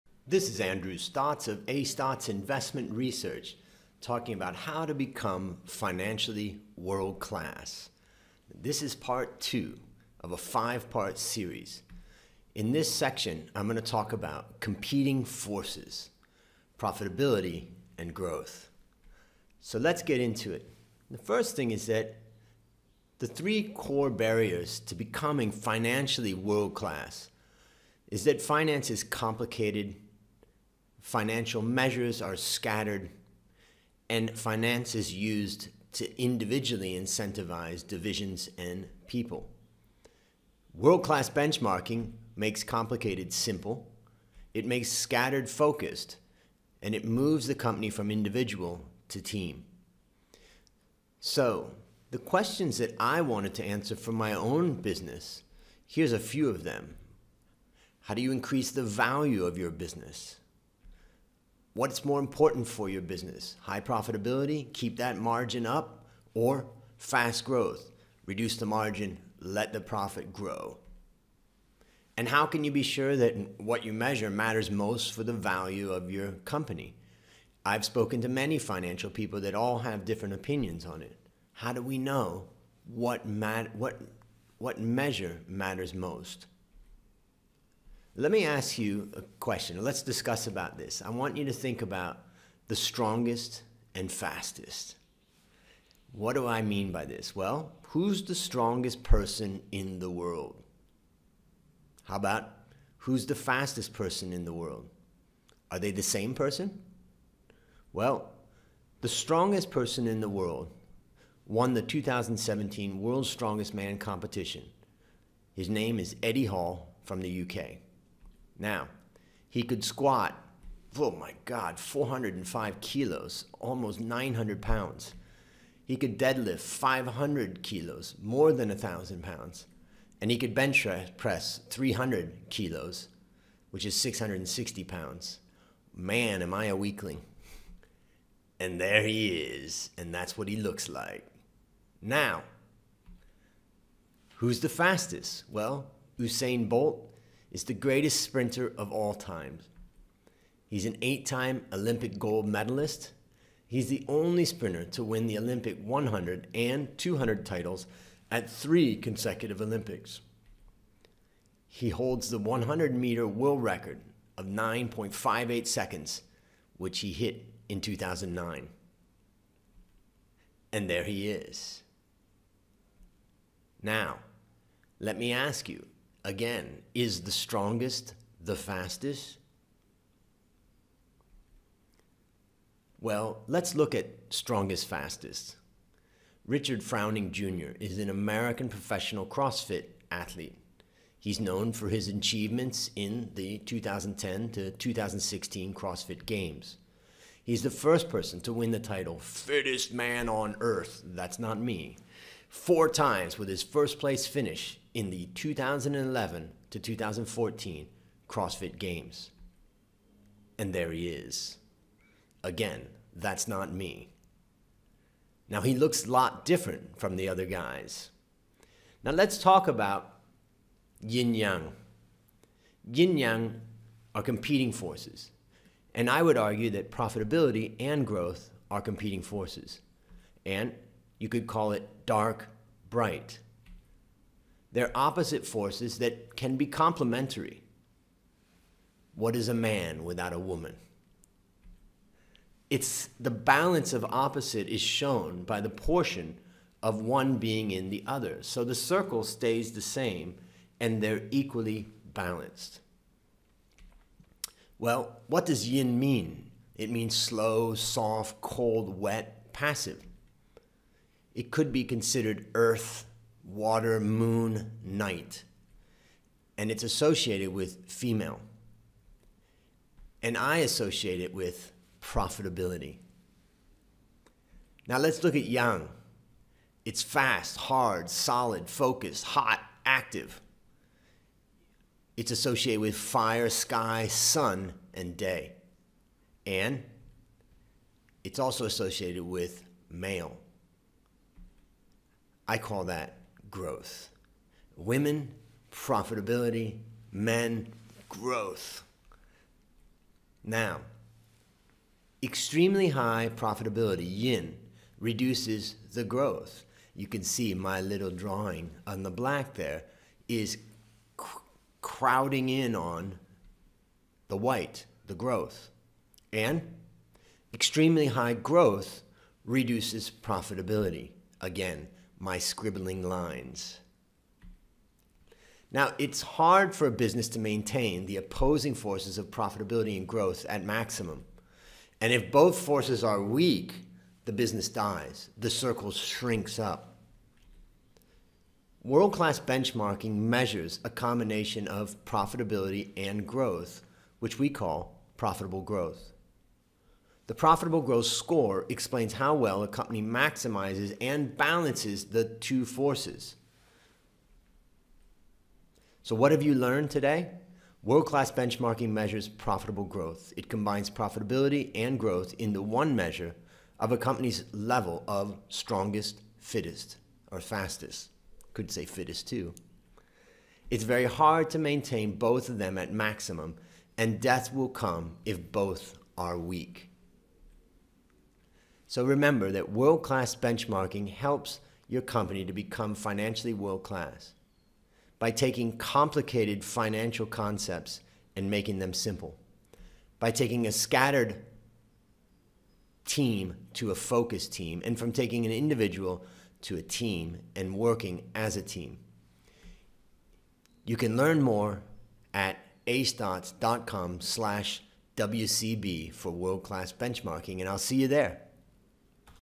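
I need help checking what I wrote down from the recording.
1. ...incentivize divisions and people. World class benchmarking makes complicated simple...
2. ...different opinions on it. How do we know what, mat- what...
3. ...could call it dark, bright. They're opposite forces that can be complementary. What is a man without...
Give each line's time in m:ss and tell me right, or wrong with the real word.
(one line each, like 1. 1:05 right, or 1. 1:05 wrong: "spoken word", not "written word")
1. 0:36 right
2. 1:20 right
3. 3:51 right.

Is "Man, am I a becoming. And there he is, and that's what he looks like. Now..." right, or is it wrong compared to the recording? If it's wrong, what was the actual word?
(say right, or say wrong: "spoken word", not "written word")
wrong: "weakling", not "becoming".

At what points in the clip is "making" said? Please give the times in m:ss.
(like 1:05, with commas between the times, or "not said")
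6:28.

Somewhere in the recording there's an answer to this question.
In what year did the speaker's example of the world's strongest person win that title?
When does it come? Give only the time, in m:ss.
1:51.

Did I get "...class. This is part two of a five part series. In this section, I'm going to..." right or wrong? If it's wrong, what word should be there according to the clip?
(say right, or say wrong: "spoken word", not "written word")
right.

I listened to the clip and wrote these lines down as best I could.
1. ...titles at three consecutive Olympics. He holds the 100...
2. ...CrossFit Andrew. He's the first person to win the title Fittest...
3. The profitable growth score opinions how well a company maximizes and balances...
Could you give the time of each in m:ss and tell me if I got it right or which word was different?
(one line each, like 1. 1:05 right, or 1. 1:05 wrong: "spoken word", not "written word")
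1. 2:37 right
2. 3:15 wrong: "Games", not "Andrew"
3. 5:47 wrong: "explains", not "opinions".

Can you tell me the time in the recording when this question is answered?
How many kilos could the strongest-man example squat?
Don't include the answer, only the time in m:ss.
2:01.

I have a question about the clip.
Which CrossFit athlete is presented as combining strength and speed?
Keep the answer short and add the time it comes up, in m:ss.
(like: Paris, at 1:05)
Richard Froning Jr., at 3:06.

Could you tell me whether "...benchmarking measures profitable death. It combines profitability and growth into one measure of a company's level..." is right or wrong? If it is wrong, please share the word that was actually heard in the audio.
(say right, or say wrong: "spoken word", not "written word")
wrong: "growth", not "death".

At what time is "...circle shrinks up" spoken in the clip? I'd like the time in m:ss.
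5:35.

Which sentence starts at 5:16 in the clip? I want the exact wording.
And extremely high growth reduces profitability.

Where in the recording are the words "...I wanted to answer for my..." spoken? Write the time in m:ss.
0:52.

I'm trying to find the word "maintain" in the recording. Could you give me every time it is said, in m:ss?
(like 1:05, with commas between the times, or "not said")
5:27, 6:11.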